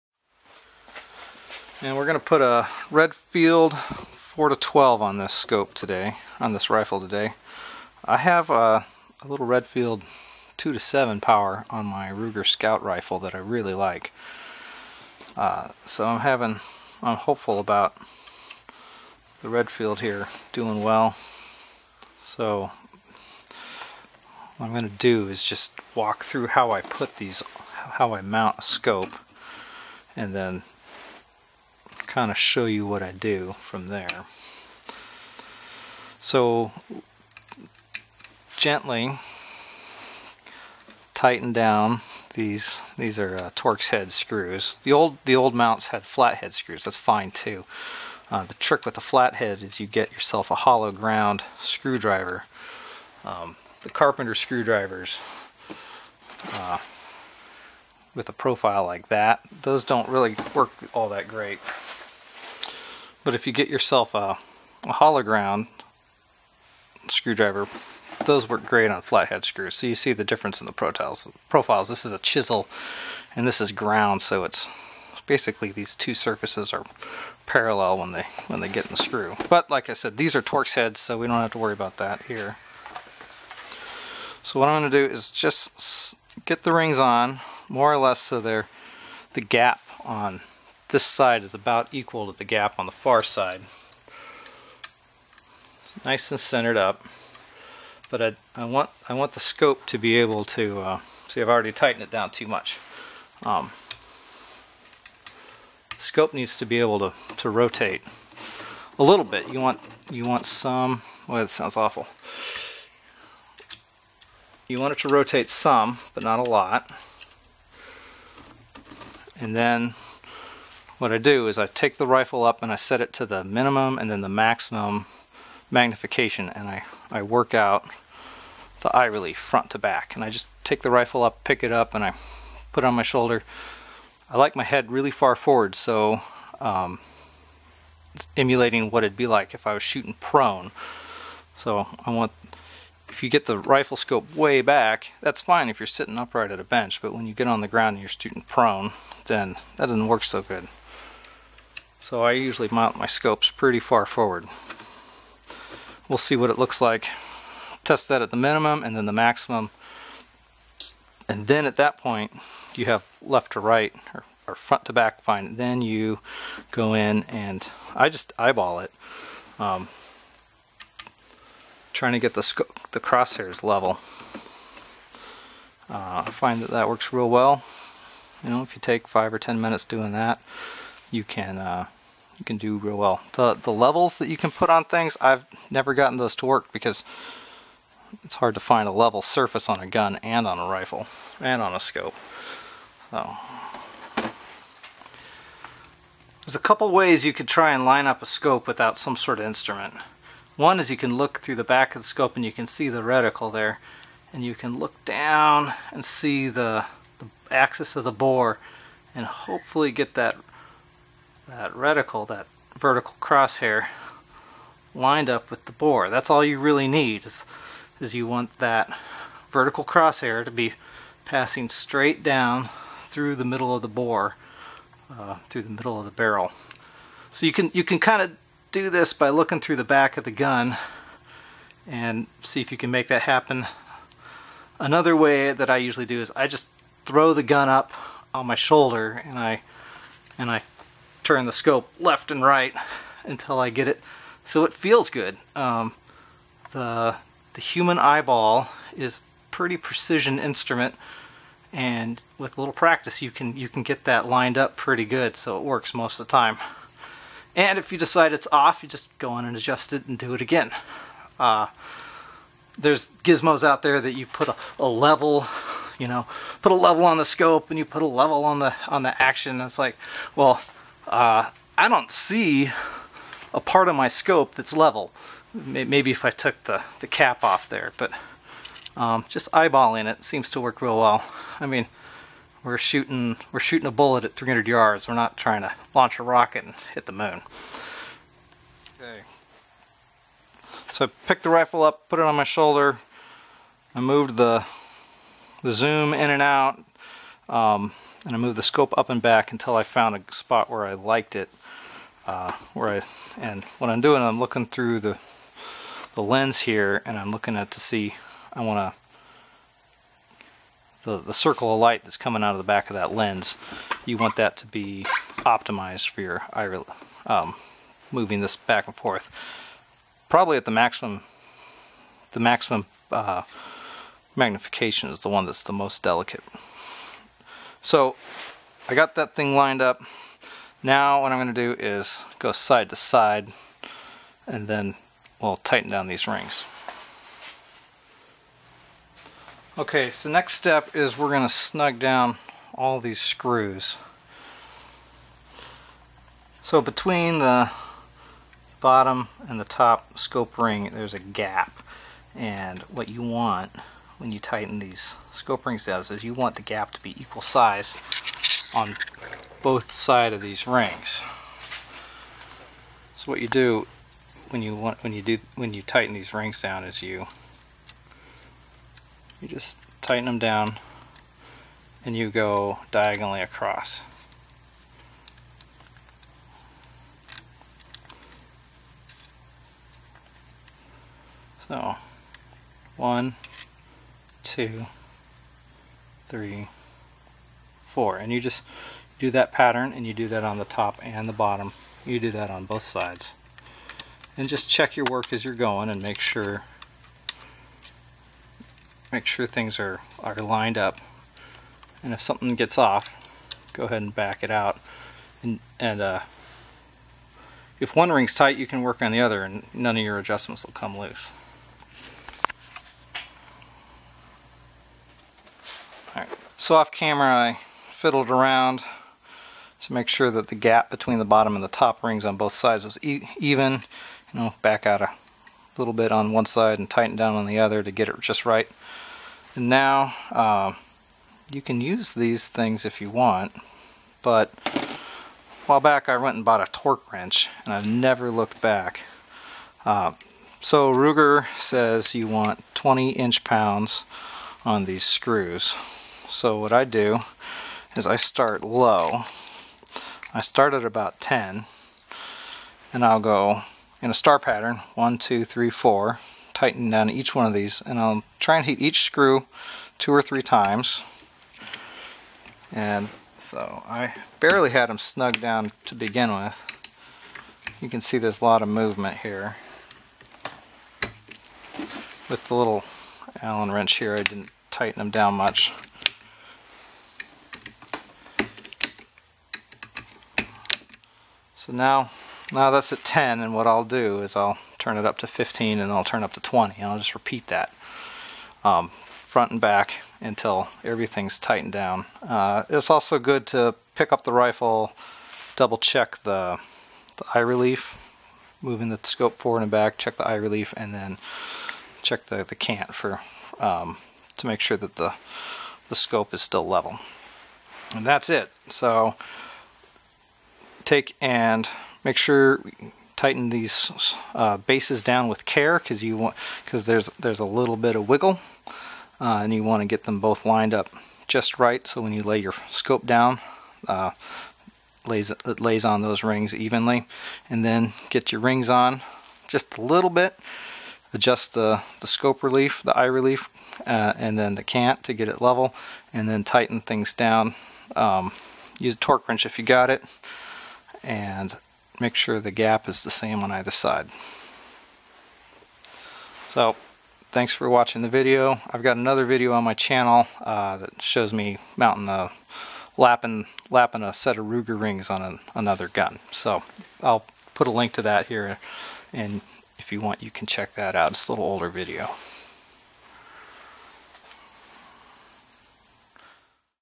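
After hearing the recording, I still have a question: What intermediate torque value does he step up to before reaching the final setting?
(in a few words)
15.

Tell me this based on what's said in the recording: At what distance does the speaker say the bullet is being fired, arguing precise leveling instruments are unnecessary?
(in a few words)
300 yards.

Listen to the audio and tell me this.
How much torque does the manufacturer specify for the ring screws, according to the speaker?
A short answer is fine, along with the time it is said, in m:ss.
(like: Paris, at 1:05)
20 inch pounds, at 7:22.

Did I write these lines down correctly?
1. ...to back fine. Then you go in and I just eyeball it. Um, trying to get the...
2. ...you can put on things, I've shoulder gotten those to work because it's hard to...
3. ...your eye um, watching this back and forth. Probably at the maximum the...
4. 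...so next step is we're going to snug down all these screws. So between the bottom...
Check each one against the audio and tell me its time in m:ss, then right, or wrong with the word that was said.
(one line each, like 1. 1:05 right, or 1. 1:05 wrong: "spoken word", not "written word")
1. 2:44 right
2. 3:04 wrong: "never", not "shoulder"
3. 5:16 wrong: "moving", not "watching"
4. 5:40 right.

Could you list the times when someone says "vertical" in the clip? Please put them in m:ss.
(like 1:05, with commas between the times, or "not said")
3:32, 3:39.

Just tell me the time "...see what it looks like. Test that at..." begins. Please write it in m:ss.
2:36.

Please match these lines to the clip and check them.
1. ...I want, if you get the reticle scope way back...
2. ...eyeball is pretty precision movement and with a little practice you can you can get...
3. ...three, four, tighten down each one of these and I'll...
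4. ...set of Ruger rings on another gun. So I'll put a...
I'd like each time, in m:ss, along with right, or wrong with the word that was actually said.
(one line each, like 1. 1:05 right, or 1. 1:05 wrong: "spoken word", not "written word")
1. 2:22 wrong: "rifle", not "reticle"
2. 4:07 wrong: "instrument", not "movement"
3. 7:35 right
4. 9:14 right.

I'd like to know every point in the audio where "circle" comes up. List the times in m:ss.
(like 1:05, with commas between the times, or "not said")
5:11.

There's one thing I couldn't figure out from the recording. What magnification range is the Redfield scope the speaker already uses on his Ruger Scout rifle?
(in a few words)
2 to 7 power.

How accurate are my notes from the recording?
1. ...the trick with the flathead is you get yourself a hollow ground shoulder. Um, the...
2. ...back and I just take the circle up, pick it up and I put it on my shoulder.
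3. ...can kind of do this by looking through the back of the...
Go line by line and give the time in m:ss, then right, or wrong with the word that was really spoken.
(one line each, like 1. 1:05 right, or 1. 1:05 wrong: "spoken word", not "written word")
1. 0:48 wrong: "screwdriver", not "shoulder"
2. 2:09 wrong: "rifle", not "circle"
3. 3:47 right.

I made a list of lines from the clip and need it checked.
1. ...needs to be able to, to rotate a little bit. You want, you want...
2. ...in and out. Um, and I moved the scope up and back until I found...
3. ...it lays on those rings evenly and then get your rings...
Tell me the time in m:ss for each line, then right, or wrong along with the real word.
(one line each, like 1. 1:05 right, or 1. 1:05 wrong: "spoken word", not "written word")
1. 1:46 right
2. 4:56 right
3. 8:45 right.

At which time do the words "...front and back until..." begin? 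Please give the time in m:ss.
8:09.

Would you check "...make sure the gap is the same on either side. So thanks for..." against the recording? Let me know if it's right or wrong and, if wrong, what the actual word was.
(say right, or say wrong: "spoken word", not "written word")
right.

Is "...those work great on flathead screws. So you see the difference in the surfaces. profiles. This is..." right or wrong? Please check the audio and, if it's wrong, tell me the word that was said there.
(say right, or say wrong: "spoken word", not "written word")
wrong: "profiles", not "surfaces".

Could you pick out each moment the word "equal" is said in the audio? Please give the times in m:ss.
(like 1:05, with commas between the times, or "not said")
1:31, 5:57.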